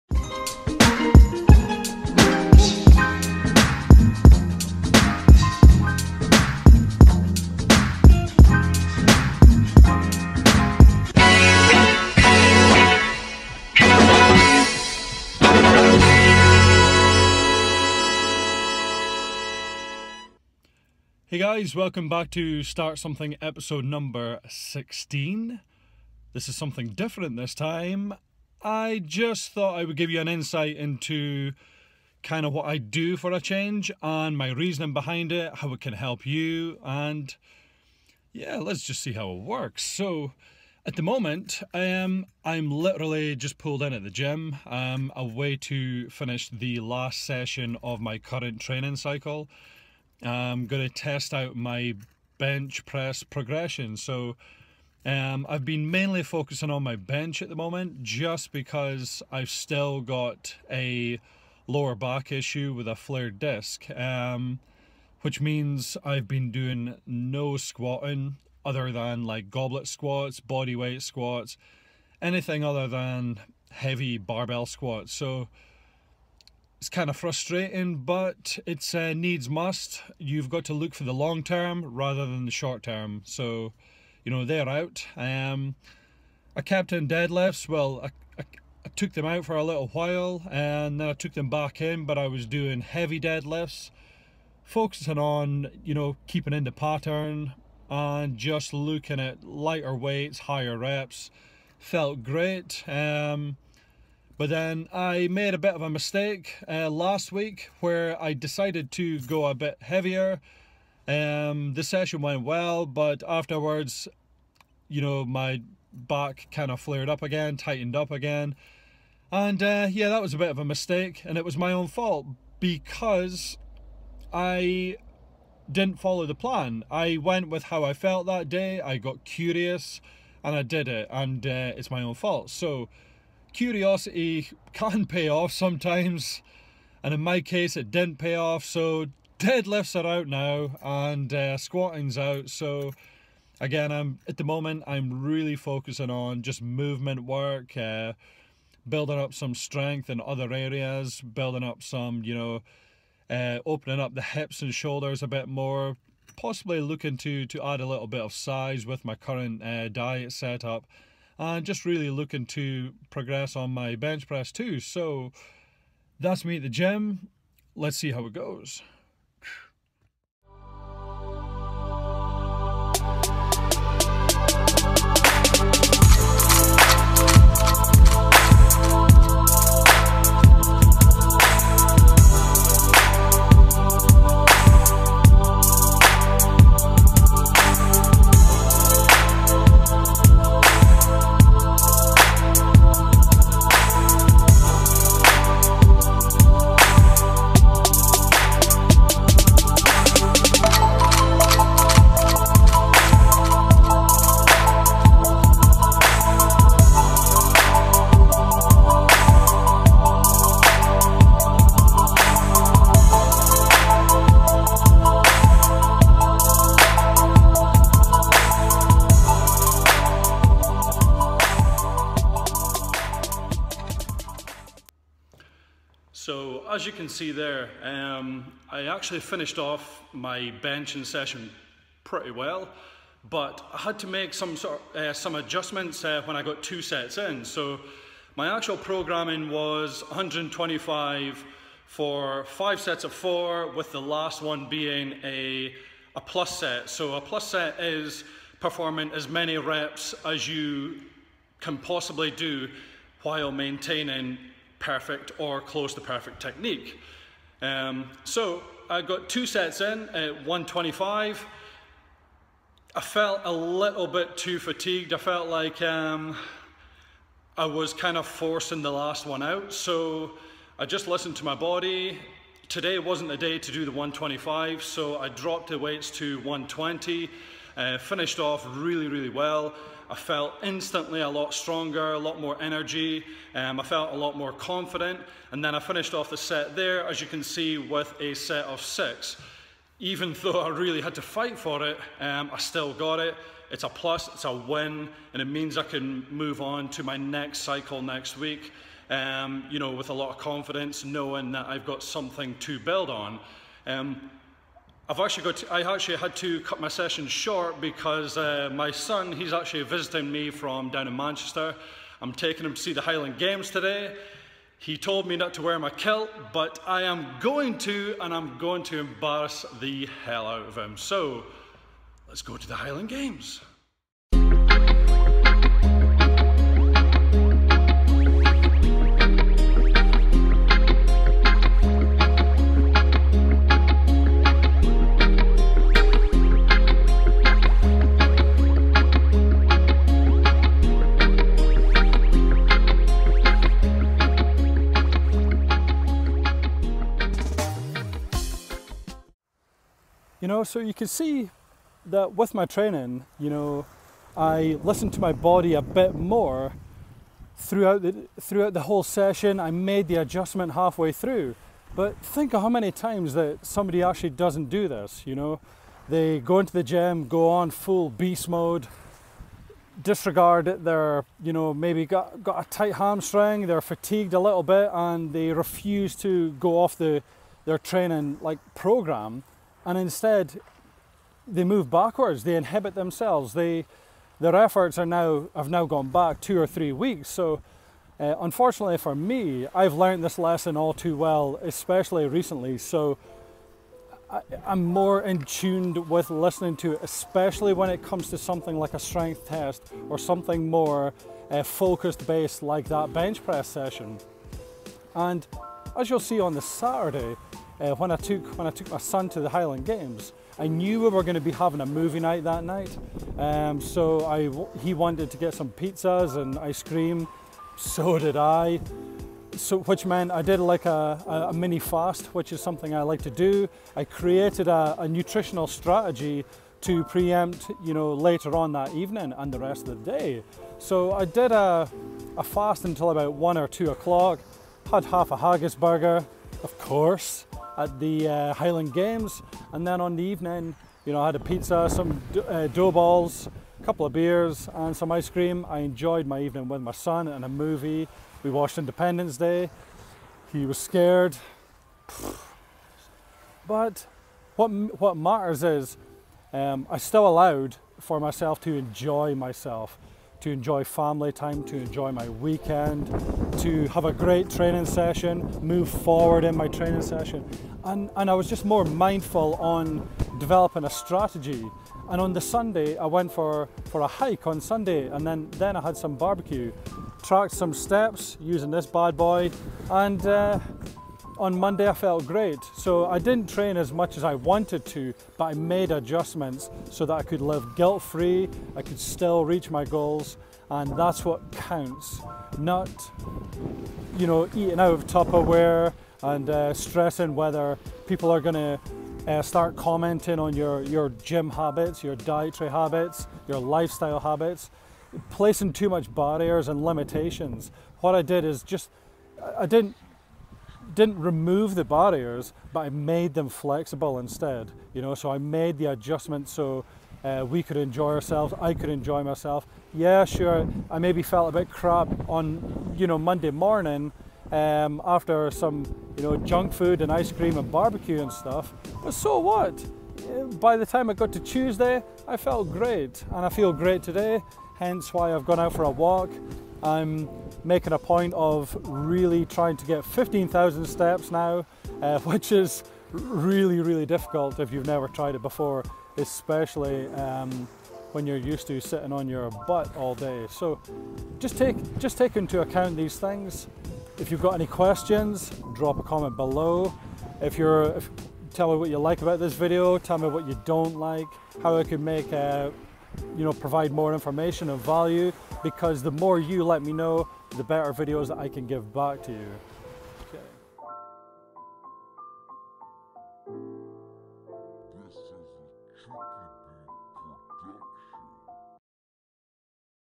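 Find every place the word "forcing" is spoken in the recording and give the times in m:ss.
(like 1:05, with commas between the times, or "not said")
4:28.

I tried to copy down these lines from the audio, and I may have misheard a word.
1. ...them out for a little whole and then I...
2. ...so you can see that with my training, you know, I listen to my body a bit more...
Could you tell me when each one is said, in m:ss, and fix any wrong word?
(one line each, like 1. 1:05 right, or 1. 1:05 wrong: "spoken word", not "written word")
1. 1:29 wrong: "while", not "whole"
2. 5:50 right.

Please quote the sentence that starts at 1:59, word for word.
And uh, yeah, that was a bit of a mistake, and it was my own fault because I didn't follow the plan.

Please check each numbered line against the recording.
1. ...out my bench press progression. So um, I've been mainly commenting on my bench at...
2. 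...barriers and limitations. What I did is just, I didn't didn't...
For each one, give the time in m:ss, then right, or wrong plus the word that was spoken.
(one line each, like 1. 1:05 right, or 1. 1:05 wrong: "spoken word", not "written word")
1. 0:51 wrong: "focusing", not "commenting"
2. 8:26 right.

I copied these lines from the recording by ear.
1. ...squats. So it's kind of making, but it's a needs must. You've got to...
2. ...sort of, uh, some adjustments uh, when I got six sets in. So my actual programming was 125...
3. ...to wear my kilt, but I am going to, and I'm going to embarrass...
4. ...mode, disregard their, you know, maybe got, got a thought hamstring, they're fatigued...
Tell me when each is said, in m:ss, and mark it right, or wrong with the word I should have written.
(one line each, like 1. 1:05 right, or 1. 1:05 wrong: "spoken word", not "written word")
1. 1:14 wrong: "frustrating", not "making"
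2. 3:54 wrong: "two", not "six"
3. 5:15 right
4. 6:08 wrong: "tight", not "thought".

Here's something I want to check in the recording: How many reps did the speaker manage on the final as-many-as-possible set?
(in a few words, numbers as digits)
6.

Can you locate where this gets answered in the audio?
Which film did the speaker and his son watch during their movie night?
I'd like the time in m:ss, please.
7:28.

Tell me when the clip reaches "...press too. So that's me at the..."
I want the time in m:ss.
2:44.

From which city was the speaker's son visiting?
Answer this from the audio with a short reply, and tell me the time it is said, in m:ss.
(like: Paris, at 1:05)
Manchester, at 5:11.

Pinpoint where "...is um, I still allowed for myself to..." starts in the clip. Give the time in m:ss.
7:35.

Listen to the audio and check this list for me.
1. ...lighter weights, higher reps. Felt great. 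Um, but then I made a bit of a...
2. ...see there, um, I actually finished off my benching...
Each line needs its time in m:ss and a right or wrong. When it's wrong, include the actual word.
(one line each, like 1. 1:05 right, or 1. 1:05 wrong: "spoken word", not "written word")
1. 1:39 right
2. 3:47 right.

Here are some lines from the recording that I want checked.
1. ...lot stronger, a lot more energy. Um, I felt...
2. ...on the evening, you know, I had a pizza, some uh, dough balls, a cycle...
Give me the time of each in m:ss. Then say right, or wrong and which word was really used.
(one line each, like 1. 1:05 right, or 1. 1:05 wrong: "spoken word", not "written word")
1. 4:41 right
2. 7:20 wrong: "couple", not "cycle".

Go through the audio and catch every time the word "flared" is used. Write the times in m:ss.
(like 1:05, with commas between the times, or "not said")
1:02, 1:56.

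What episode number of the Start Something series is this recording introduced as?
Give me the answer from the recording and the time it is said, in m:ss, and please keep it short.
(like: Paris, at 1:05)
16, at 0:24.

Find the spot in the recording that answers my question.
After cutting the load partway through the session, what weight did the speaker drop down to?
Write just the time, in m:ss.
4:36.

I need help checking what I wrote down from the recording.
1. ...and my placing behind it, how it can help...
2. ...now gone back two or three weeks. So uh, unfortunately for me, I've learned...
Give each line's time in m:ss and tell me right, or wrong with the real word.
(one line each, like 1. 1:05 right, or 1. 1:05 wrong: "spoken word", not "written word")
1. 0:34 wrong: "reasoning", not "placing"
2. 6:25 right.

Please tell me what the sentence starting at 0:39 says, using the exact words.
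So, at the moment, um, I'm literally just pulled in at the gym.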